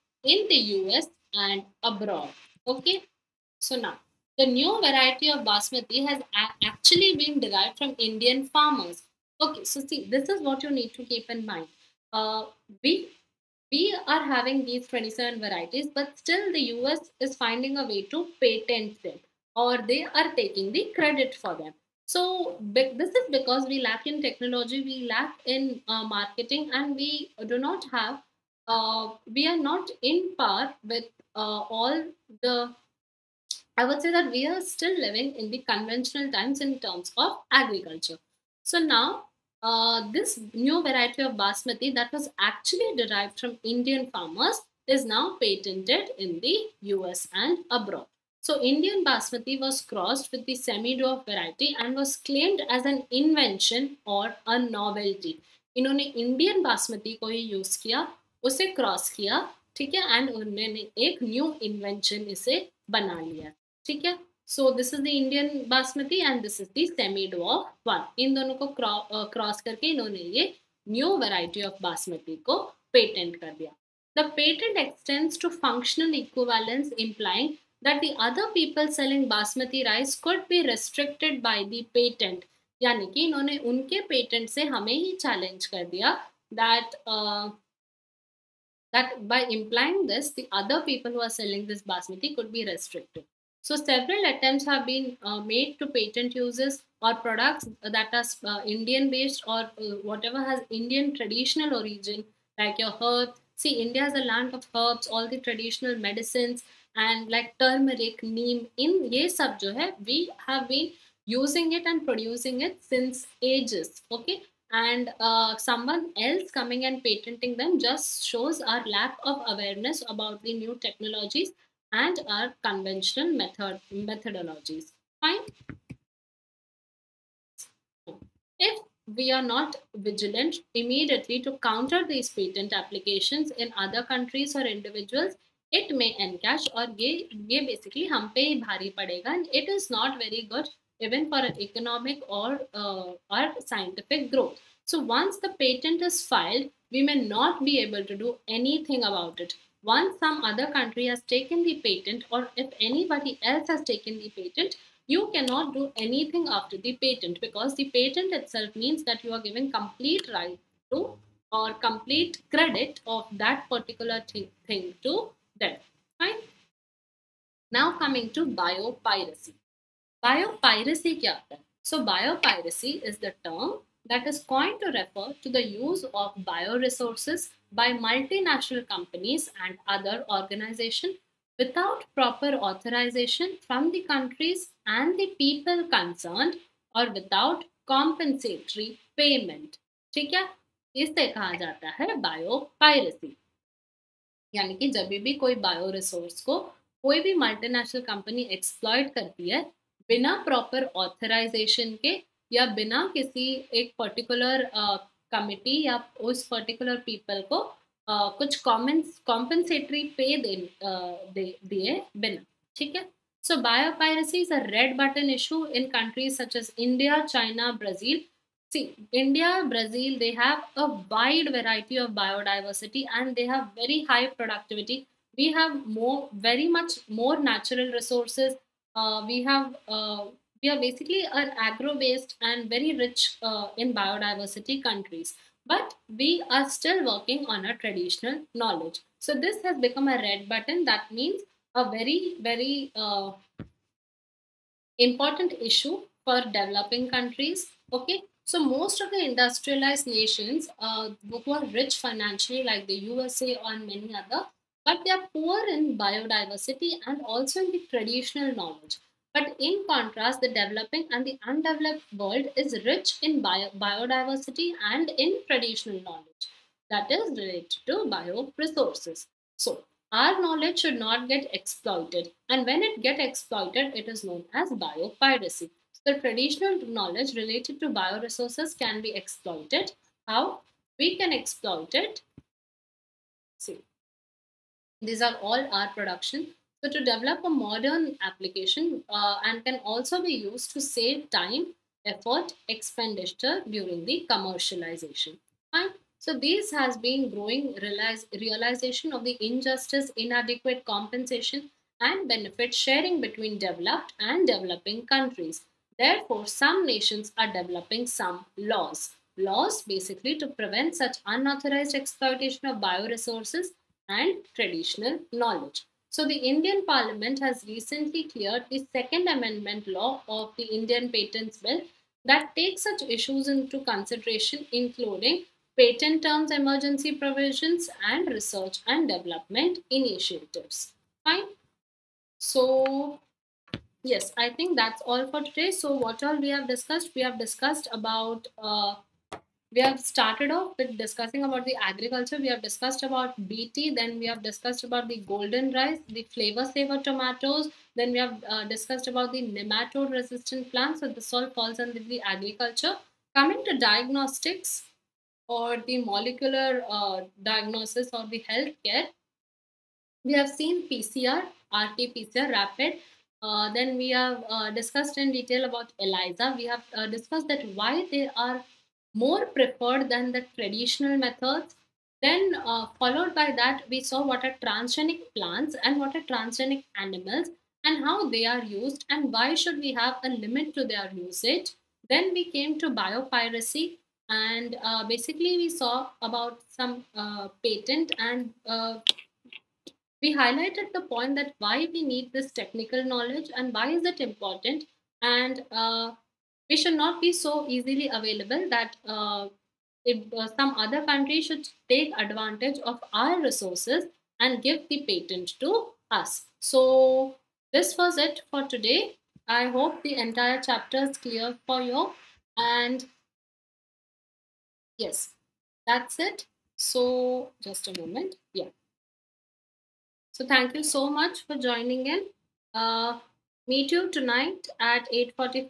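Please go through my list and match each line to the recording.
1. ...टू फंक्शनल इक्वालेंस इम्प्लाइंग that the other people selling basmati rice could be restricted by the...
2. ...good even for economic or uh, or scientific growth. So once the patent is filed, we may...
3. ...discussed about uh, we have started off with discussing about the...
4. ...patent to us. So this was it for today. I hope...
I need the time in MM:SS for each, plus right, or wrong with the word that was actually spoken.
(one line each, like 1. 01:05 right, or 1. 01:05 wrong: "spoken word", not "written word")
1. 01:15 right
2. 02:20 right
3. 05:37 right
4. 06:45 right.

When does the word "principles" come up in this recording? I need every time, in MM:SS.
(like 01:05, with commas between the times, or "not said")
not said.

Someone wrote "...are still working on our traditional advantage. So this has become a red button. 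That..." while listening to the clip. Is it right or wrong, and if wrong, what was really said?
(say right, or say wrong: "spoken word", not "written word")
wrong: "knowledge", not "advantage".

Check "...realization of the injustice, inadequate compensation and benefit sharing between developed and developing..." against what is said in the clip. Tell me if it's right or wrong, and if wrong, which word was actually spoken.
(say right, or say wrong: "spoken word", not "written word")
right.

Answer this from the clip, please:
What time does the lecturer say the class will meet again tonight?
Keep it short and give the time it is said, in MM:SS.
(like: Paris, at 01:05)
8:45, at 07:05.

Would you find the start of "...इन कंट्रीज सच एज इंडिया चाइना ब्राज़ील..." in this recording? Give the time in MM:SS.
03:35.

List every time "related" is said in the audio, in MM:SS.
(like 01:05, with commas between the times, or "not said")
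04:27, 04:37.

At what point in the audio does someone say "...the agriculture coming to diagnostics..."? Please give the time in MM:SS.
05:52.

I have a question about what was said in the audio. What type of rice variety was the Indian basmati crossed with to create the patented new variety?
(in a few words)
Semi-dwarf variety.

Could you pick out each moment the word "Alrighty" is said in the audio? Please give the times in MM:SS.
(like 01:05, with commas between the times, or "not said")
not said.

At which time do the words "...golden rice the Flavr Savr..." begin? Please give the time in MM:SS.
05:45.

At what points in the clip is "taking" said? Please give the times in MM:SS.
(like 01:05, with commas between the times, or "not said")
00:20.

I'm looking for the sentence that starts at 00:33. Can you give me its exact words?
I would say that we are still living in the conventional times in terms of agriculture.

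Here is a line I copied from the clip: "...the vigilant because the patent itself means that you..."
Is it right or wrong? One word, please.
wrong.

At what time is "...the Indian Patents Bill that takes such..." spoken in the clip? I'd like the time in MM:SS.
05:20.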